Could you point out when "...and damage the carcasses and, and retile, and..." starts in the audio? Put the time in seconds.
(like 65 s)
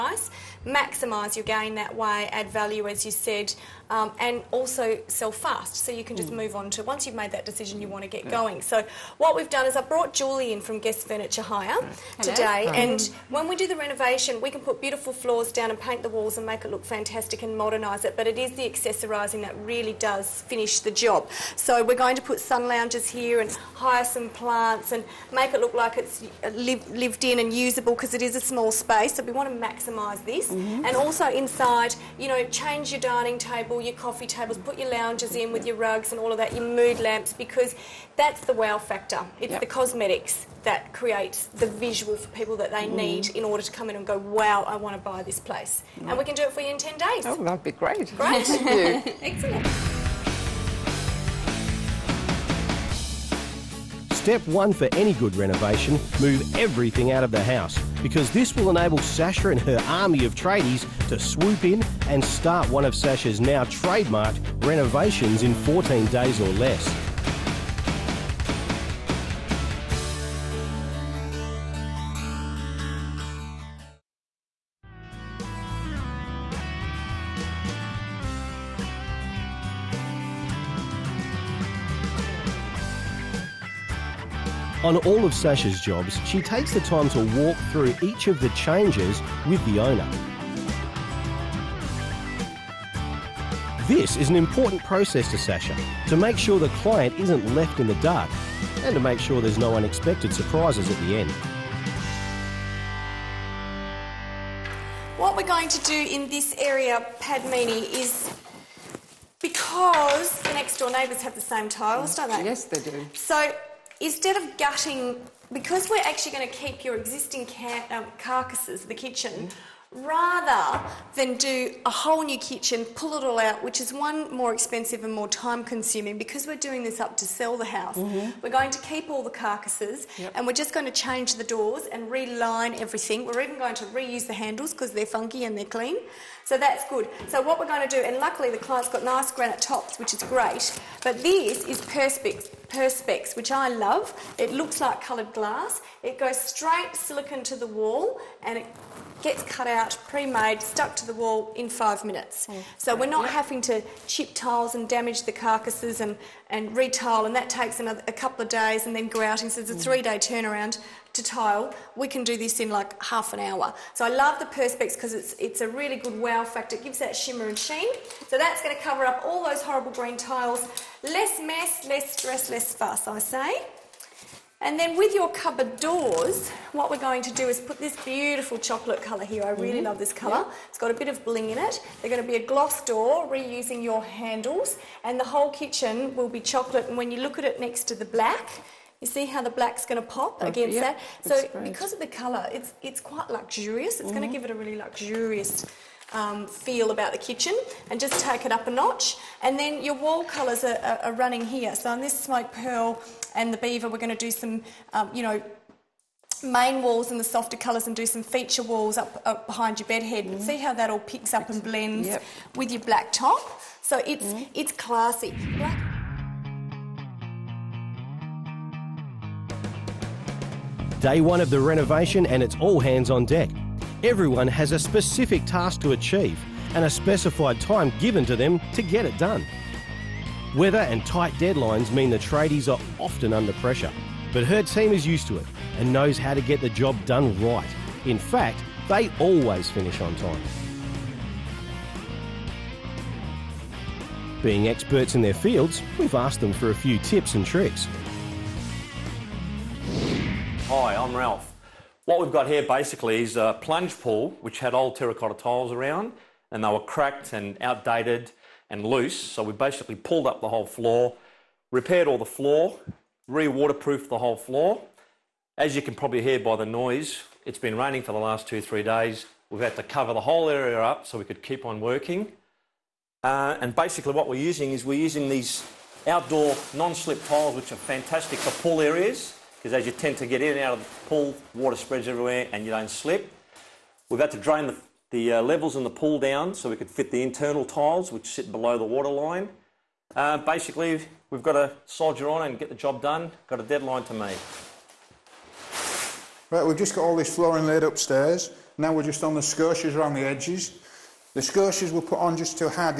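154 s.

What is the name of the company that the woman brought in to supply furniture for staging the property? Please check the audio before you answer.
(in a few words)
Guest Furniture Hire.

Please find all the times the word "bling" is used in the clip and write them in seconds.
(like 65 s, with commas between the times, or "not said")
181 s.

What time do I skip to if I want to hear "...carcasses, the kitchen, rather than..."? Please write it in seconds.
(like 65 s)
118 s.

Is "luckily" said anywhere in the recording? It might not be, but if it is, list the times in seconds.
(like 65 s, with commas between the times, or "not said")
138 s.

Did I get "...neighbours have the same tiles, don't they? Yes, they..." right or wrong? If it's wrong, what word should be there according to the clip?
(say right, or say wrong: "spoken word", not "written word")
right.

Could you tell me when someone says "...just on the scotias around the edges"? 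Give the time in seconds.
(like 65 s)
299 s.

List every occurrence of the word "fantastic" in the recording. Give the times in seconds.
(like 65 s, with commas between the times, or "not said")
16 s, 277 s.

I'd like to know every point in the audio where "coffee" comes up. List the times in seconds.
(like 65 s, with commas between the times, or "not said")
34 s.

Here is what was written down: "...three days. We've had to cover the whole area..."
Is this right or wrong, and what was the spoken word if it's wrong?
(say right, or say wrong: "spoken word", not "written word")
right.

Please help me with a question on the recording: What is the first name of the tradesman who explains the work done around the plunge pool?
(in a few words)
Ralph.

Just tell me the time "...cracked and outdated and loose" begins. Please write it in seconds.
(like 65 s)
256 s.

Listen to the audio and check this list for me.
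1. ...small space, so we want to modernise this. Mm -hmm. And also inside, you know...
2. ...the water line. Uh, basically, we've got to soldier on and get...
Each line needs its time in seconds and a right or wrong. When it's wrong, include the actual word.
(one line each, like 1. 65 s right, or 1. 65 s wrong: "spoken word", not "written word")
1. 28 s wrong: "maximise", not "modernise"
2. 288 s right.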